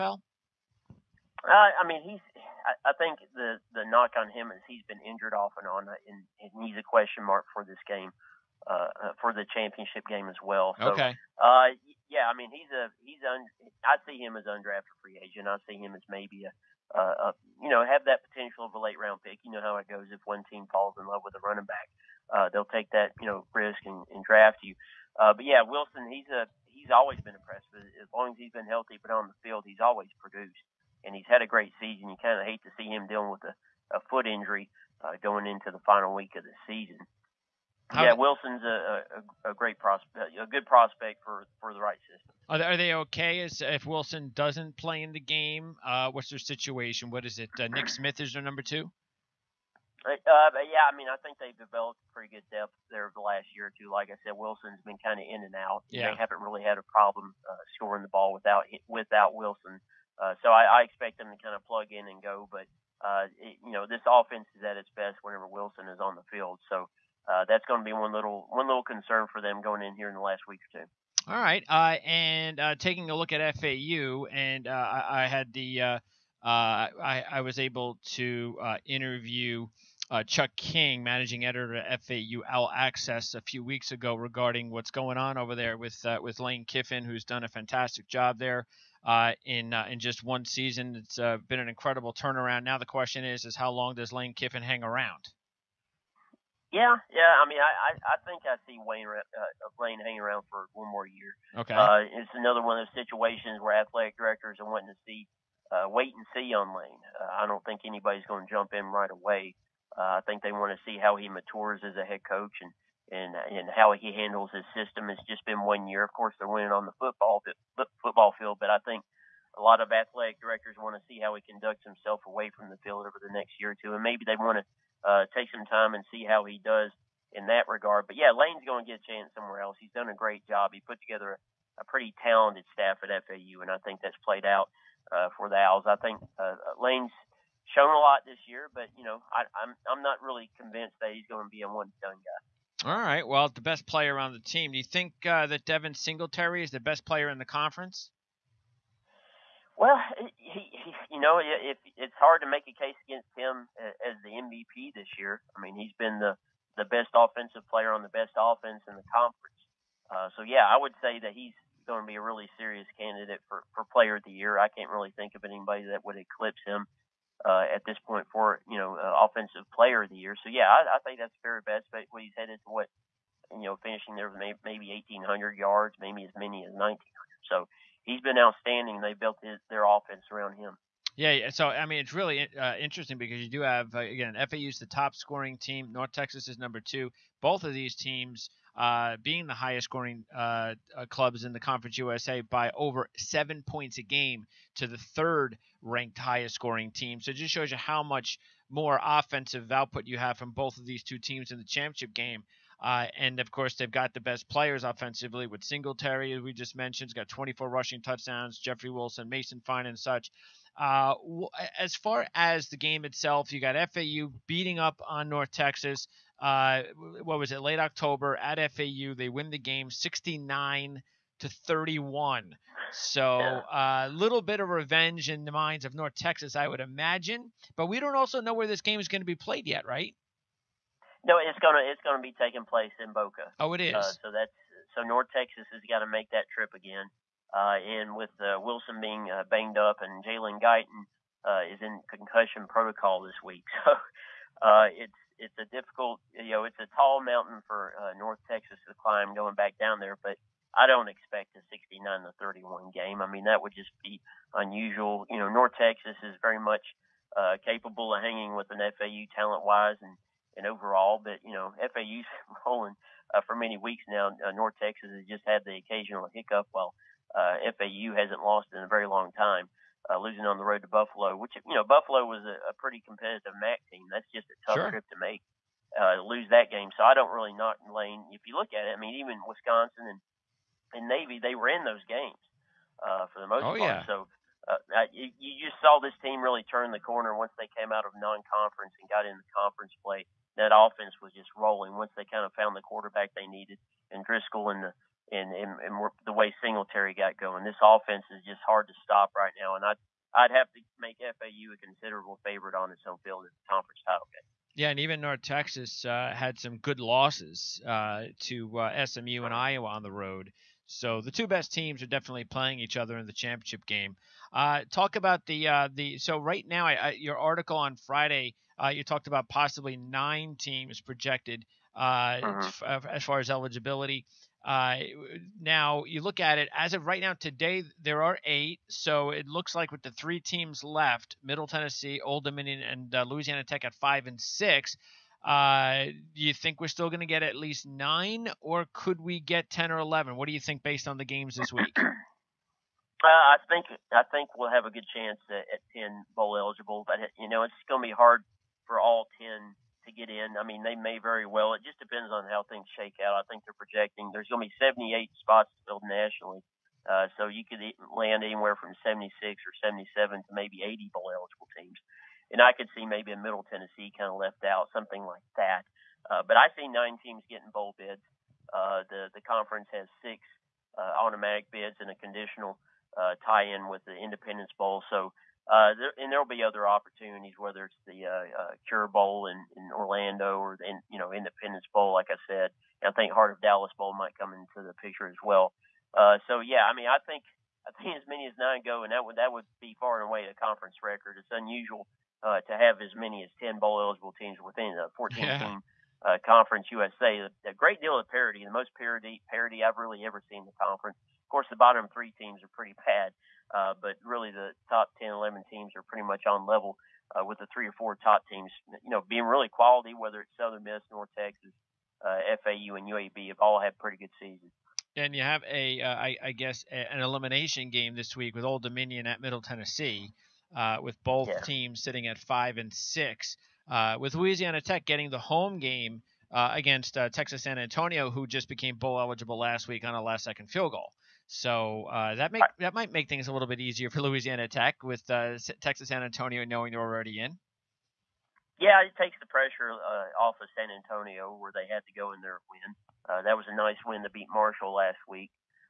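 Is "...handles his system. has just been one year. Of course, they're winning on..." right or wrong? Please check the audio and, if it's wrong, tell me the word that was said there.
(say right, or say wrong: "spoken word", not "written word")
right.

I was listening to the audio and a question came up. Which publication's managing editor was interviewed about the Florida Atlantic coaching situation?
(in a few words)
FAU Owl Access.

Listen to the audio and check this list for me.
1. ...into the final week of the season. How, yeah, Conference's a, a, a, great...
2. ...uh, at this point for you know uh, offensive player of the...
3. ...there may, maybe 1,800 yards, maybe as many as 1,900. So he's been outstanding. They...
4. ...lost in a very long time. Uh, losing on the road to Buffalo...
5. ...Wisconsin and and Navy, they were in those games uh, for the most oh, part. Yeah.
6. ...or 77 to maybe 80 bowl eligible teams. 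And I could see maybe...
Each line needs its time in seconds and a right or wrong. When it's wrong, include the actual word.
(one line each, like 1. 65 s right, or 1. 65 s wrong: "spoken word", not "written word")
1. 35 s wrong: "Wilson", not "Conference"
2. 167 s right
3. 174 s right
4. 268 s right
5. 279 s right
6. 359 s right.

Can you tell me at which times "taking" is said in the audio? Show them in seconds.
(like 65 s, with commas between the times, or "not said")
72 s, 232 s.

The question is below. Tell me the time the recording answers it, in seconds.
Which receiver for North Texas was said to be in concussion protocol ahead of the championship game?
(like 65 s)
240 s.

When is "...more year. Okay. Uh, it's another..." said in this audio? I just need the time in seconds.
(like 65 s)
100 s.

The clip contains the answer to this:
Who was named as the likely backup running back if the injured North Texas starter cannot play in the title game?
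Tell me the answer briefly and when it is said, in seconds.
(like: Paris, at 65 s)
Nick Smith, at 47 s.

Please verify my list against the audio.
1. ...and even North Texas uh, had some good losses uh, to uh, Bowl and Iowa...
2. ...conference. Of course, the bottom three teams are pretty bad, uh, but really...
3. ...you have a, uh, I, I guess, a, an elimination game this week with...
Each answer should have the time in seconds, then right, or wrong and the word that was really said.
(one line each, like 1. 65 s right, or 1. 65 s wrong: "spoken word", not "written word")
1. 304 s wrong: "SMU", not "Bowl"
2. 400 s right
3. 415 s right.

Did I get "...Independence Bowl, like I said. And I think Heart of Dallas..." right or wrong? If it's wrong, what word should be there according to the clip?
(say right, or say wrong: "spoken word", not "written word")
right.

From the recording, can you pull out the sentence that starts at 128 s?
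But yeah, Lane's going to get a chance somewhere else.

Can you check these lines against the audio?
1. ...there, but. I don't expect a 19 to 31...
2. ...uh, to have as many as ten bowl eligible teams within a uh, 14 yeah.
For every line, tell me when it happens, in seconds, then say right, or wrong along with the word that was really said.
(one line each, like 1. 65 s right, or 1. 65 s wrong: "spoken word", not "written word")
1. 249 s wrong: "69", not "19"
2. 392 s right.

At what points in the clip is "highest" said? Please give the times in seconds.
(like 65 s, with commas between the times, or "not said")
189 s, 196 s.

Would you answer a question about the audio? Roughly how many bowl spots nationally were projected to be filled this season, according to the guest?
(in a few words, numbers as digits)
78.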